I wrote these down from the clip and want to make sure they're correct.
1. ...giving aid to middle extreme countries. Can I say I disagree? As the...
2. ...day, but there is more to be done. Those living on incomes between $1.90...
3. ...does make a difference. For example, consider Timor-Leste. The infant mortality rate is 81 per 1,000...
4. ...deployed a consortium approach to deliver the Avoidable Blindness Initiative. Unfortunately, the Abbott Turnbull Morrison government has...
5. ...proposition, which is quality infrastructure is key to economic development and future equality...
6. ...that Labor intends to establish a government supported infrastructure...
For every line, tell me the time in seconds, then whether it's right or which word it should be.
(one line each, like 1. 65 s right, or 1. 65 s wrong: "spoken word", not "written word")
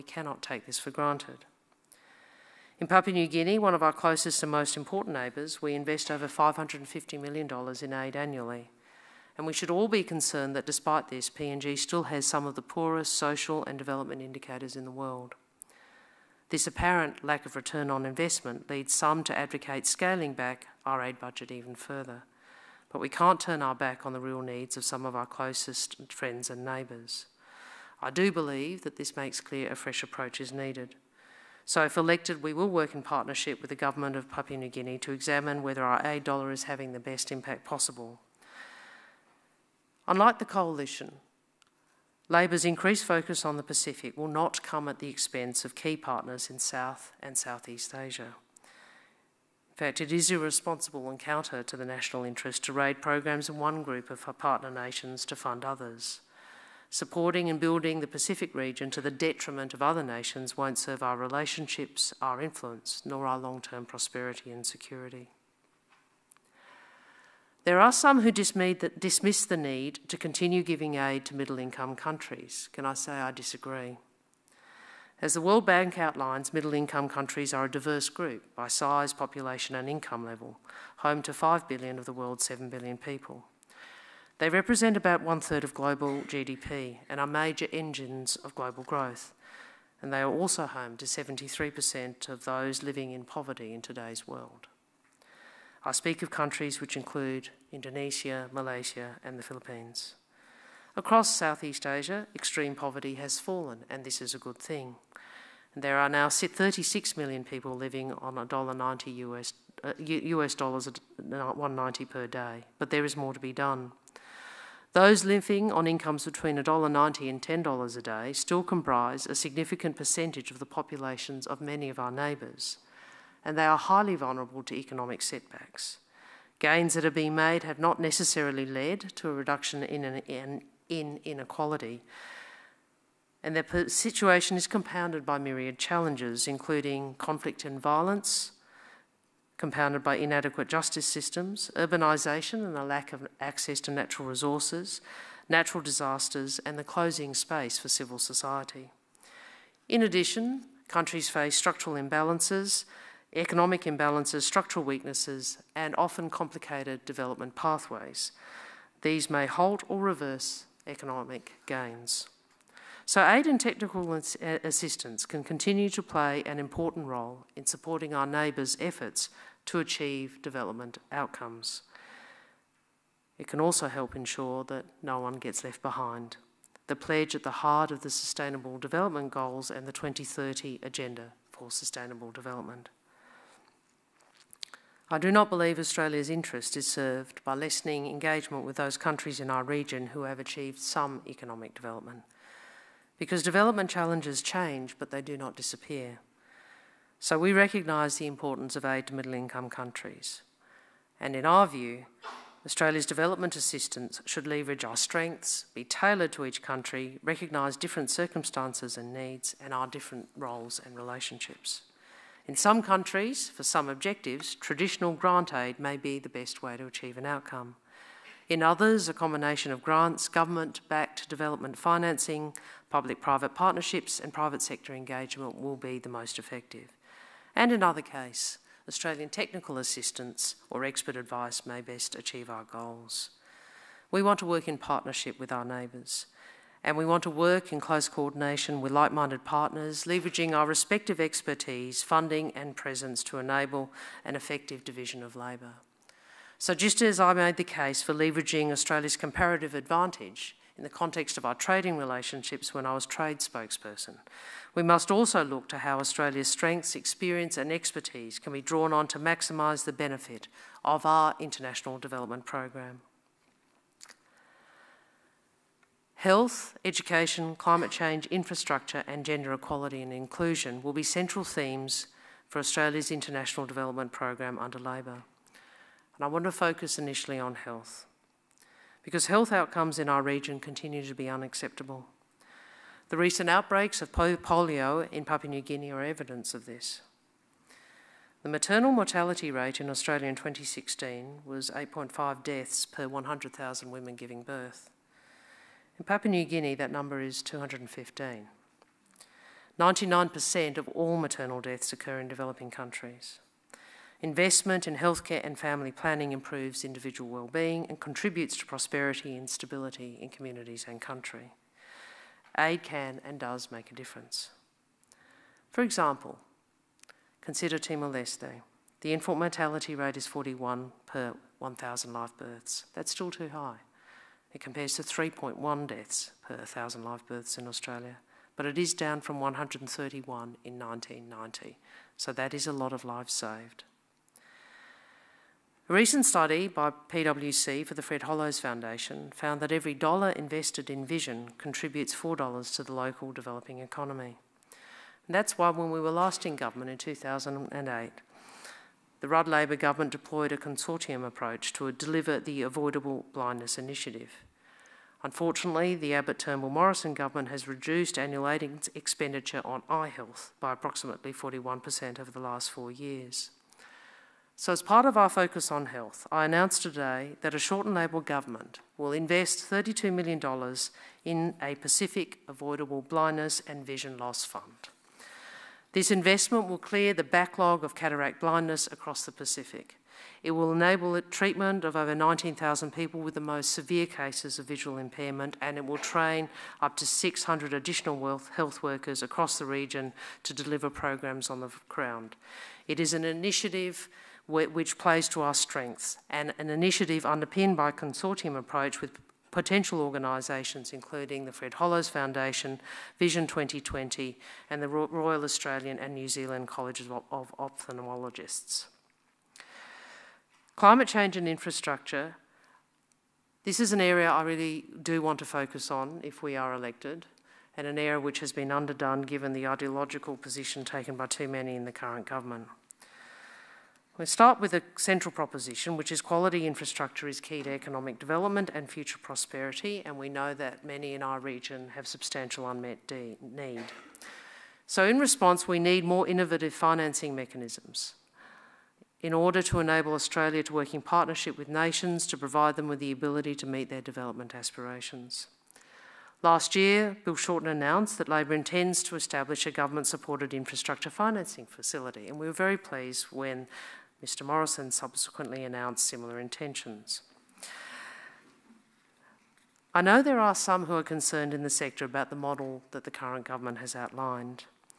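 1. 70 s wrong: "income", not "extreme"
2. 112 s right
3. 313 s wrong: "41", not "81"
4. 350 s right
5. 425 s wrong: "prosperity", not "equality"
6. 448 s right.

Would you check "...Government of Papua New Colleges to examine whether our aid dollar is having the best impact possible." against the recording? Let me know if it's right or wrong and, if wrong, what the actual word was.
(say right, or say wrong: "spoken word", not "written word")
wrong: "Guinea", not "Colleges".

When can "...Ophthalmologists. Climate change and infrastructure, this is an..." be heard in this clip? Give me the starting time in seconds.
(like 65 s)
407 s.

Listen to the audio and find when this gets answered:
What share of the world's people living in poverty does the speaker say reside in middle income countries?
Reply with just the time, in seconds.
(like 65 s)
91 s.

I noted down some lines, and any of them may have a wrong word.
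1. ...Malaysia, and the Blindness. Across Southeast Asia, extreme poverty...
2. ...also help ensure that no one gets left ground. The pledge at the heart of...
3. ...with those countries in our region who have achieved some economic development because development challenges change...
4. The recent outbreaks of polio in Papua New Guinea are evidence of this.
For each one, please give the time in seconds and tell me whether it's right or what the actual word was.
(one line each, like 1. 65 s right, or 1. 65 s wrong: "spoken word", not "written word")
1. 98 s wrong: "Philippines", not "Blindness"
2. 173 s wrong: "behind", not "ground"
3. 188 s right
4. 283 s right.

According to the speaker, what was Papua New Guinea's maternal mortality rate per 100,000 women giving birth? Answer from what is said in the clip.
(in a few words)
215.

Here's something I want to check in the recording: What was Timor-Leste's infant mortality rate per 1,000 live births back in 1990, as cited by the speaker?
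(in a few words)
131.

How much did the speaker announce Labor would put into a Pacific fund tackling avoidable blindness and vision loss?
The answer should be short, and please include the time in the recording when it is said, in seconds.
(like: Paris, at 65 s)
$32 million, at 369 s.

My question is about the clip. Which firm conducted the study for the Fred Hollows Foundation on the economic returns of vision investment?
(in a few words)
PwC.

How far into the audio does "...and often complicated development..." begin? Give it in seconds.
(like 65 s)
155 s.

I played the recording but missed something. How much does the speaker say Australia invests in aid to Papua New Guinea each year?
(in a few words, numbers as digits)
Over $550 million.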